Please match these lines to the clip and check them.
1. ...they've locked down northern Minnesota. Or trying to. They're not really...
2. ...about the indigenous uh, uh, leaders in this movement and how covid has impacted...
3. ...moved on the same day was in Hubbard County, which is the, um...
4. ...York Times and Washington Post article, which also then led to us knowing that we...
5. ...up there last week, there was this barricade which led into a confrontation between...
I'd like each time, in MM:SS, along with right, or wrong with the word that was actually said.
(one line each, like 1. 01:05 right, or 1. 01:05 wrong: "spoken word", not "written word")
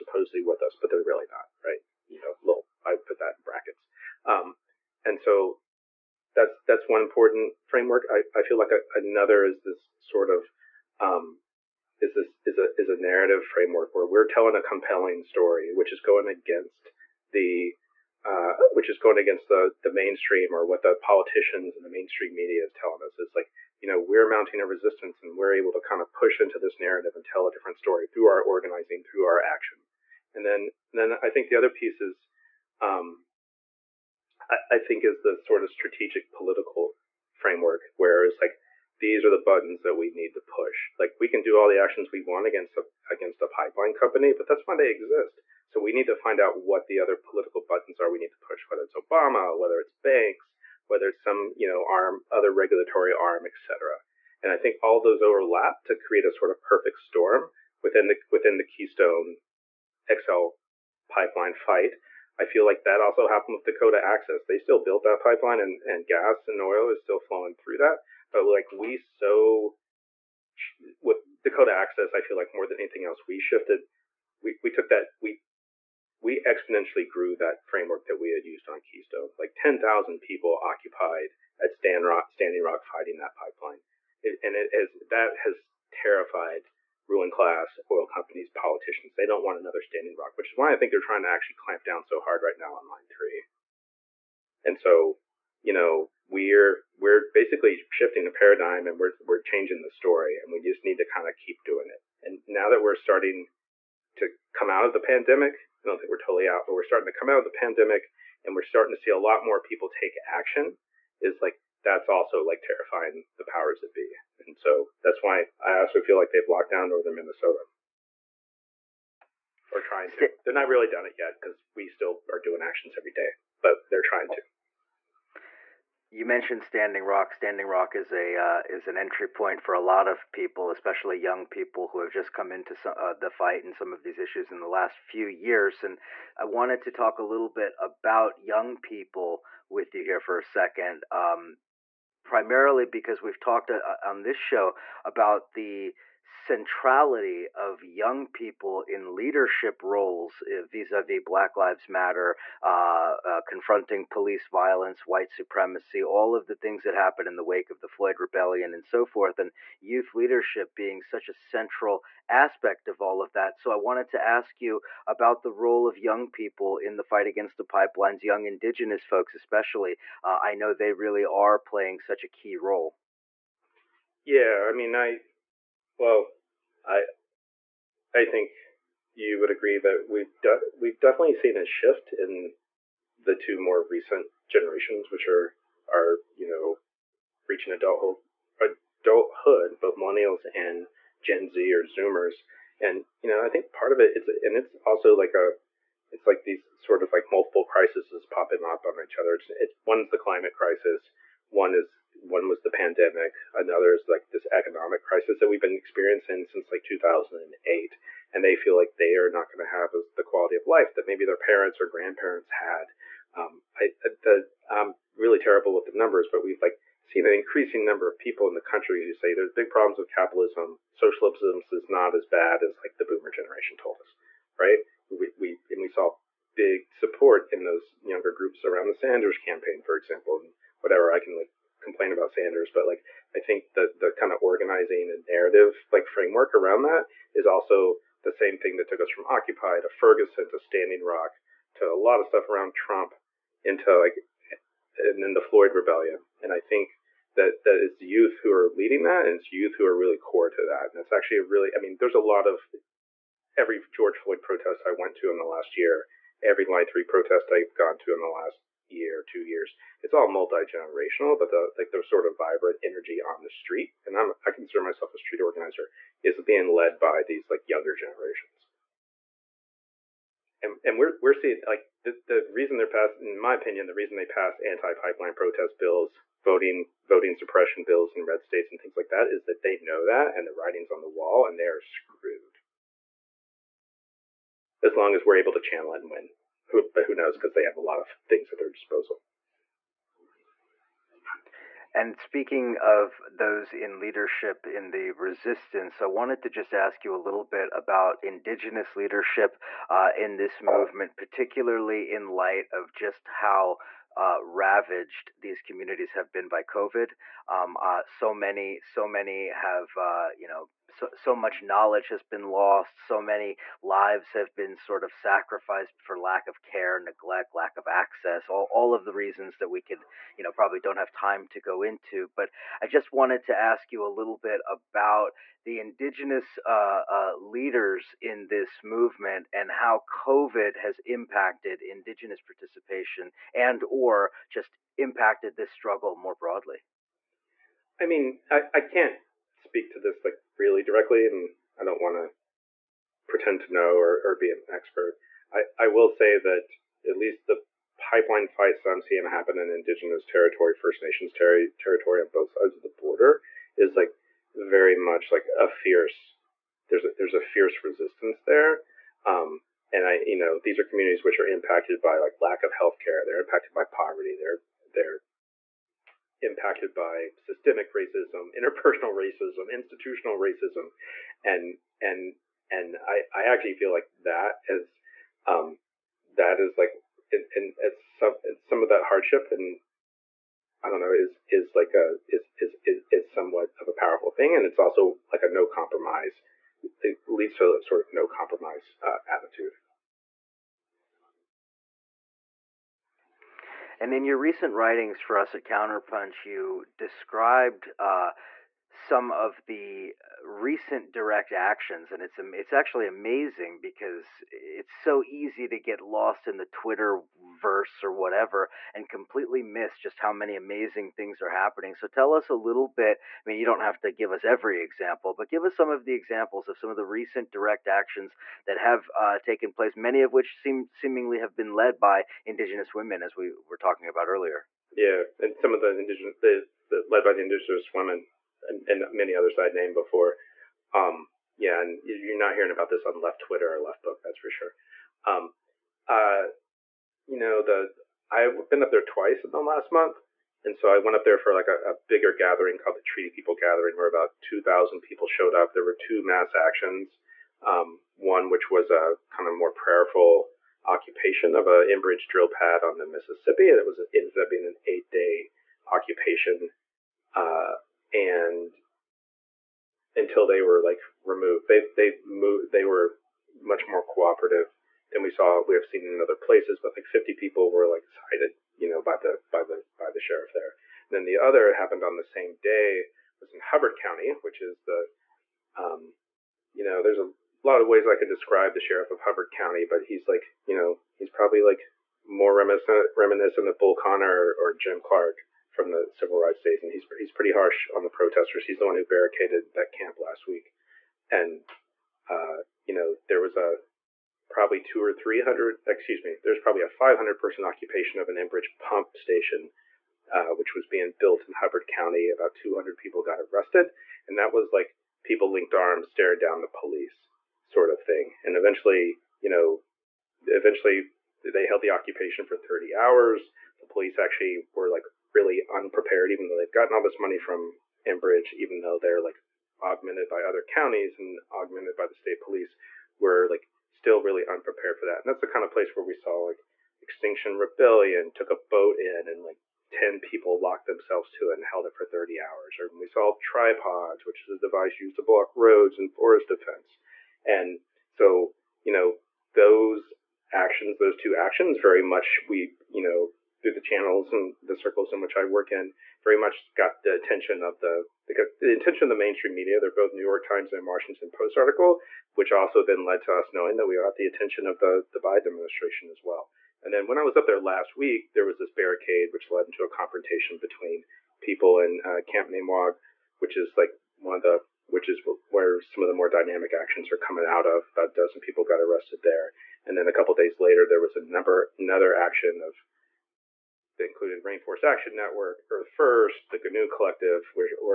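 1. 01:56 right
2. 05:24 right
3. 07:51 wrong: "happened", not "moved"
4. 09:10 right
5. 09:17 right.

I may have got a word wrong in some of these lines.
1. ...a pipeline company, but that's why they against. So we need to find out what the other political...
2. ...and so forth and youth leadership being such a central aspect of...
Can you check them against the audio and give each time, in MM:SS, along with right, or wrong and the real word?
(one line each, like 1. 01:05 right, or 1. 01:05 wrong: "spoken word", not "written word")
1. 00:43 wrong: "exist", not "against"
2. 02:38 right.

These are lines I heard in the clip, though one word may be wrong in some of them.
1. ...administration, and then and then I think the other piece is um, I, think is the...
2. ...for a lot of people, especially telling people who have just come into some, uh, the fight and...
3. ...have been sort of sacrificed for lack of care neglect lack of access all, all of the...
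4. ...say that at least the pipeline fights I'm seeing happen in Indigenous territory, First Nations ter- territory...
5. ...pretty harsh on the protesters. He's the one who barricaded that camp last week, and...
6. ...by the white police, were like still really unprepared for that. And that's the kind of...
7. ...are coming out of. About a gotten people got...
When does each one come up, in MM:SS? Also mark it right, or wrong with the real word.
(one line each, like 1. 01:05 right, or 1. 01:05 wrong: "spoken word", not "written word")
1. 00:29 wrong: "action", not "administration"
2. 02:09 wrong: "young", not "telling"
3. 05:14 right
4. 05:46 right
5. 08:07 right
6. 08:41 wrong: "state", not "white"
7. 09:27 wrong: "dozen", not "gotten".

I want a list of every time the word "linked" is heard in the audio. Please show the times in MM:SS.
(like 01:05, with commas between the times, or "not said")
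08:25.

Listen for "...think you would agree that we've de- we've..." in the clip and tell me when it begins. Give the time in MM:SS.
02:58.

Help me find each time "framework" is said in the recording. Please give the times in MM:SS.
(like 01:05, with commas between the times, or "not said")
00:07, 00:13, 00:37, 01:17, 03:56.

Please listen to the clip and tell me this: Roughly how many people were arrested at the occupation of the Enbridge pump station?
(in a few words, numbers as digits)
200.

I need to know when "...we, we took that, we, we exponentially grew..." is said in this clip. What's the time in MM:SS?
01:14.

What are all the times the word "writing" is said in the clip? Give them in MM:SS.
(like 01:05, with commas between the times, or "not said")
04:40, 06:34.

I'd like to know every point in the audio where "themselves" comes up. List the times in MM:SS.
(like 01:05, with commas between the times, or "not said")
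08:50.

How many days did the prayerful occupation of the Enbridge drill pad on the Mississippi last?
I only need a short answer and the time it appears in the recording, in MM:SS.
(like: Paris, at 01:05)
8, at 07:34.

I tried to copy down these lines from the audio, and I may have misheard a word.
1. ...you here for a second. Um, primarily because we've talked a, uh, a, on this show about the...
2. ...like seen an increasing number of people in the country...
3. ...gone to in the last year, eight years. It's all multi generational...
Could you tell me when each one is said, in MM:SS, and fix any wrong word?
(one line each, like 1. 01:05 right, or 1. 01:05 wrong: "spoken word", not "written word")
1. 02:19 right
2. 03:36 right
3. 04:17 wrong: "two", not "eight".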